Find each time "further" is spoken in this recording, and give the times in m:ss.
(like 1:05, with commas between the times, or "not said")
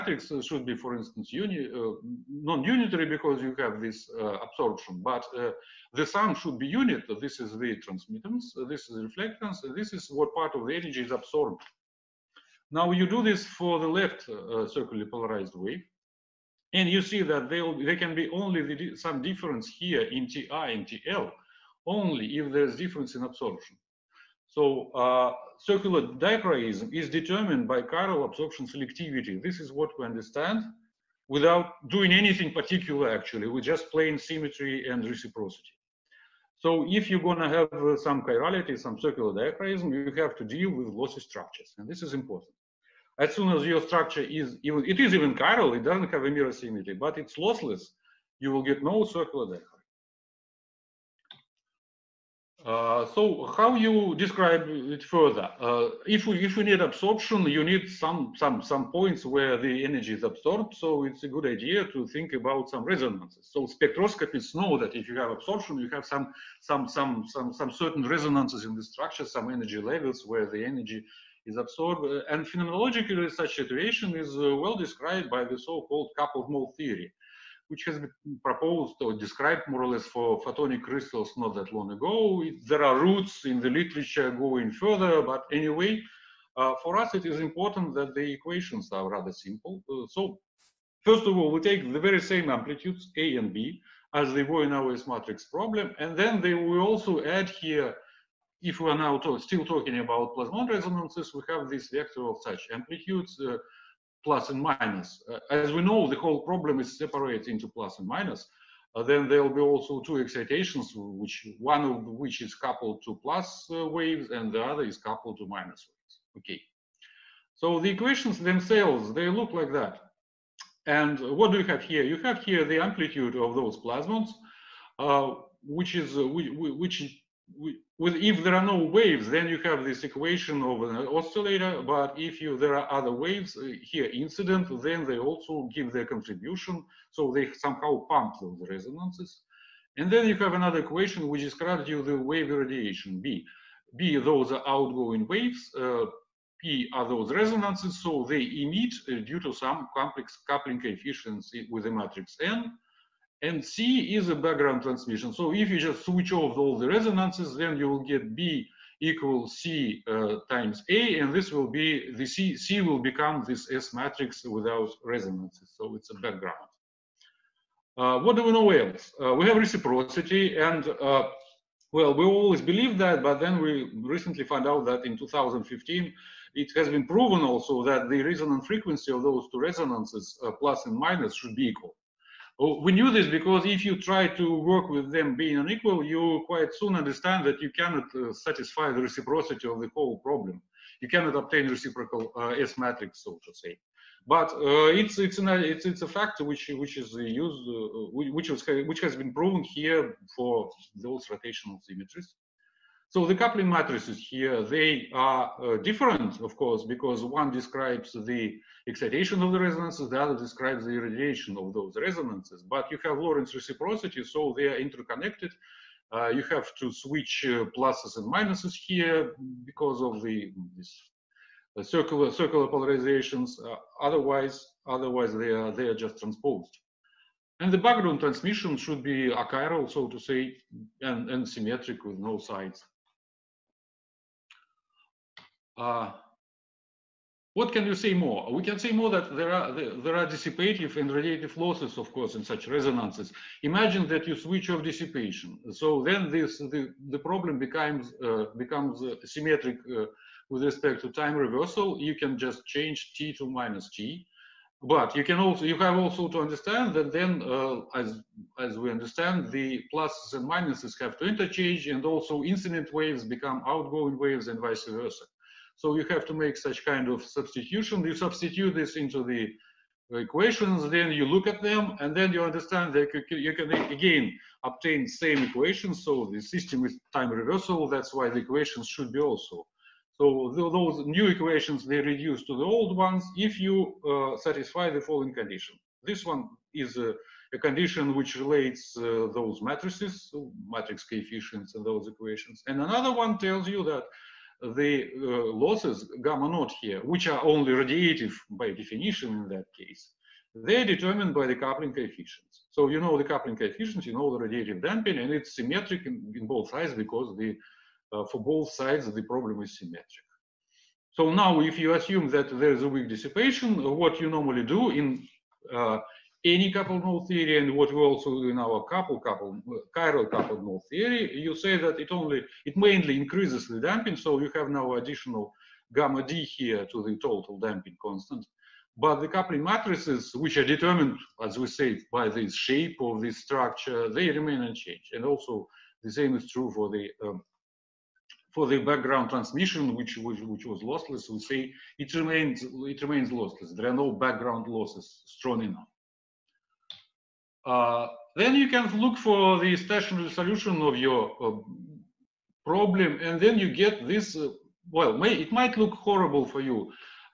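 0:55, 1:24.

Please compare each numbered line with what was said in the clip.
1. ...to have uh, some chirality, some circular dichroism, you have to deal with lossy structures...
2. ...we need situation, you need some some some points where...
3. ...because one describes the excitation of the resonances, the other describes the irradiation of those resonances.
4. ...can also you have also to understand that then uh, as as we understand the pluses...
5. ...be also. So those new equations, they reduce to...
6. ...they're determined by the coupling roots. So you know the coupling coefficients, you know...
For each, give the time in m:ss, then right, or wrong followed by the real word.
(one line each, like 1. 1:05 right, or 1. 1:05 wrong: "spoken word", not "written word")
1. 0:37 right
2. 0:56 wrong: "absorption", not "situation"
3. 3:26 right
4. 4:15 right
5. 4:39 right
6. 5:00 wrong: "coefficients", not "roots".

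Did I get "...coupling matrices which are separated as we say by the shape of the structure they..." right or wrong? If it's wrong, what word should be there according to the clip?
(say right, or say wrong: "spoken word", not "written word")
wrong: "determined", not "separated".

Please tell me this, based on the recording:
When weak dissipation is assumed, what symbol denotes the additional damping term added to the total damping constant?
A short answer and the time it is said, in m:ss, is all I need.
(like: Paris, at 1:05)
gamma d, at 5:25.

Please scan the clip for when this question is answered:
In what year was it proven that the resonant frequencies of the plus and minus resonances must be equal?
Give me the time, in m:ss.
2:55.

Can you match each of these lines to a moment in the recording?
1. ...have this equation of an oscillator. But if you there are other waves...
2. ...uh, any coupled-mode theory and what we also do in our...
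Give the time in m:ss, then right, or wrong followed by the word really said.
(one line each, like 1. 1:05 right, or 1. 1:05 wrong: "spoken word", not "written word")
1. 2:09 right
2. 5:15 right.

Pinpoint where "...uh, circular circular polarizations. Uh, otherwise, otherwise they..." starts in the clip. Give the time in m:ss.
3:41.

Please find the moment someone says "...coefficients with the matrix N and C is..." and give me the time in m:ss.
2:30.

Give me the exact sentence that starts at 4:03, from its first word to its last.
Imagine that you switch off dissipation.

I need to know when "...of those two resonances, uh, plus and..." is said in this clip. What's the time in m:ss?
2:59.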